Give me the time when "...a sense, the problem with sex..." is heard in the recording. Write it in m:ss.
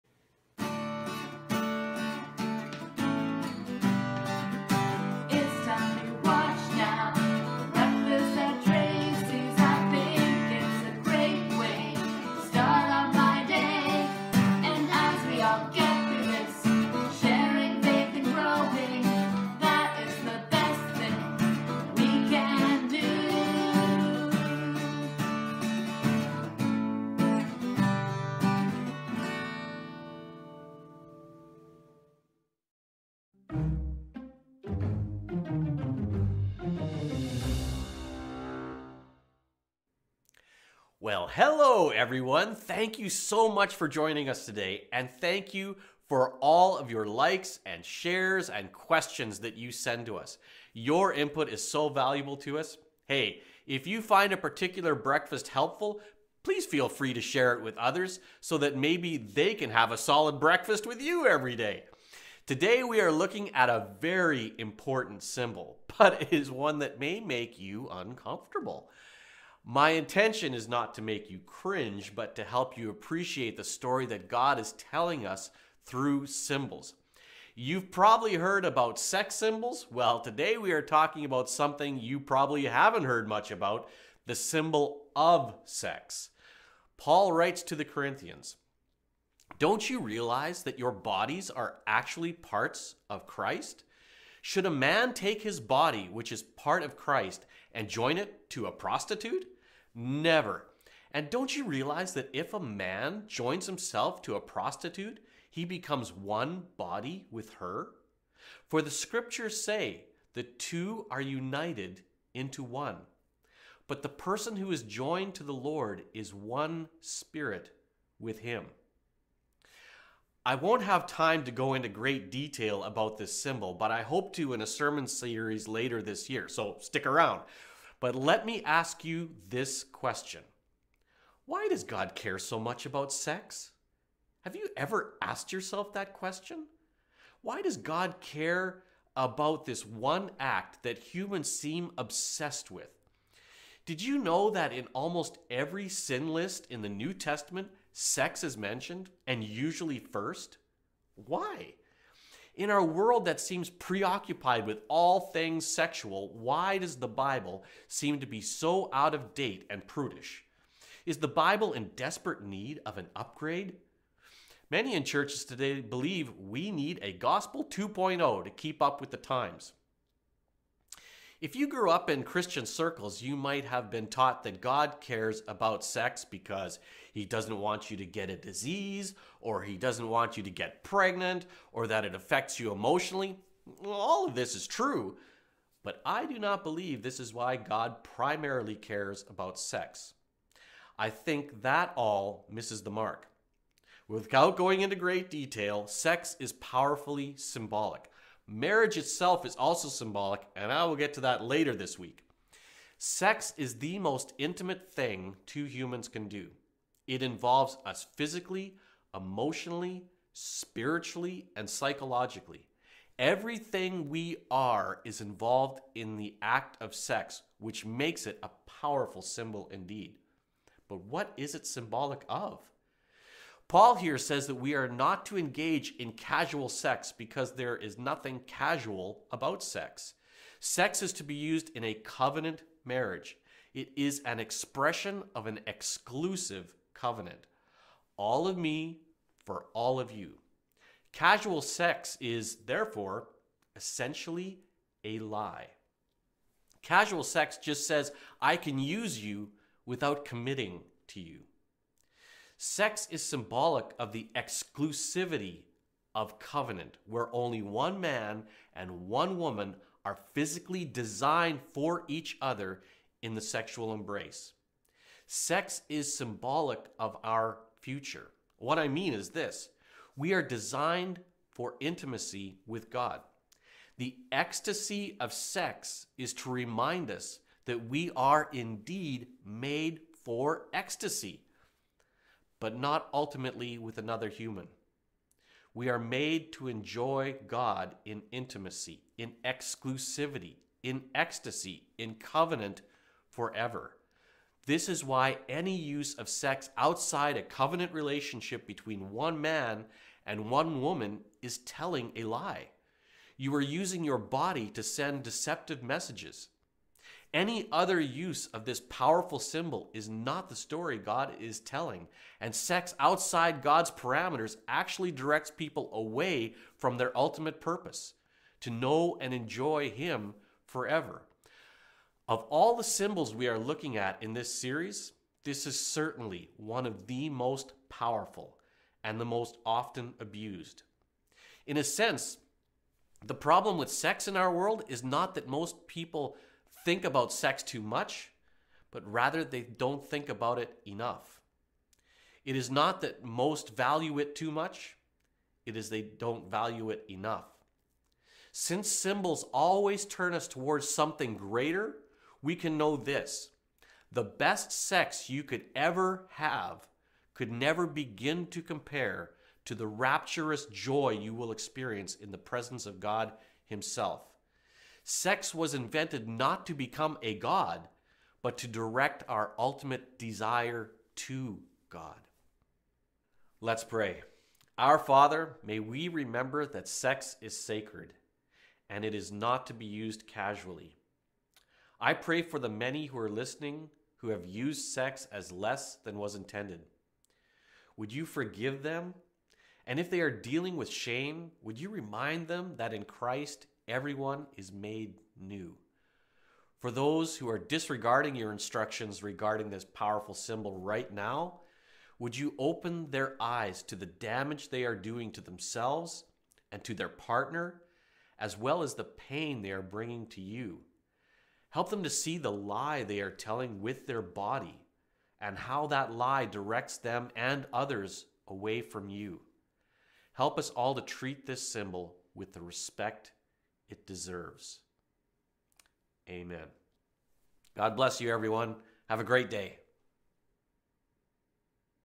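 5:31.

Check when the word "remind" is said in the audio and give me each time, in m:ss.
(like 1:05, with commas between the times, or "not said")
4:36, 6:31.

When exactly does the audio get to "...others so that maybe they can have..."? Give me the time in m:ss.
0:57.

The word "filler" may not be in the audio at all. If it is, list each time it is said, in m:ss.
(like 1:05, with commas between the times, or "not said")
not said.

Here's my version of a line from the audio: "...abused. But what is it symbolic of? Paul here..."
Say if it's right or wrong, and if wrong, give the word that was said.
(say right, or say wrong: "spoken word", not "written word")
wrong: "indeed", not "abused".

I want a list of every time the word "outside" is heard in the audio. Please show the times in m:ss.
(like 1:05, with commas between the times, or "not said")
4:56, 5:12.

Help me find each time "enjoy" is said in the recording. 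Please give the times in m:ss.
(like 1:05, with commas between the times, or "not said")
4:46, 5:19.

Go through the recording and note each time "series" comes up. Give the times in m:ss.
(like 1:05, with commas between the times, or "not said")
2:05, 5:24.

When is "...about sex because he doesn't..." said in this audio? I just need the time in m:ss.
2:55.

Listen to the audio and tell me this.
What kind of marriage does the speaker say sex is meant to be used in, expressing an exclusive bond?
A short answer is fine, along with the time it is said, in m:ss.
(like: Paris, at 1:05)
A covenant marriage, at 3:51.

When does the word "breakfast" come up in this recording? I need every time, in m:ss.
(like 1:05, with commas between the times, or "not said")
0:54, 1:00.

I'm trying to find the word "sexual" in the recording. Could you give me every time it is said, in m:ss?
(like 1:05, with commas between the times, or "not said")
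2:35, 4:23.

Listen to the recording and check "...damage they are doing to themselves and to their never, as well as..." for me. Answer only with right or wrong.
wrong.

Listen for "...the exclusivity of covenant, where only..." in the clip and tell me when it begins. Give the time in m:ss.
4:14.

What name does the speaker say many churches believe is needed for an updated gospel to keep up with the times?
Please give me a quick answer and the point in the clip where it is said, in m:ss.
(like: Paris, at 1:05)
Gospel 2.0, at 2:47.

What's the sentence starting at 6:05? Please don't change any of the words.
Sex was invented not to become a God, but to direct our ultimate desire to God.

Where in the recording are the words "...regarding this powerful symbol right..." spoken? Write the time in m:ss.
6:39.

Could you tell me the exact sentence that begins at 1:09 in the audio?
My intention is not to make you cringe, but to help you appreciate the story that God is telling us through symbols.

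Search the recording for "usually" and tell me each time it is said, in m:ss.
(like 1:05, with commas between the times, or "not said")
2:29.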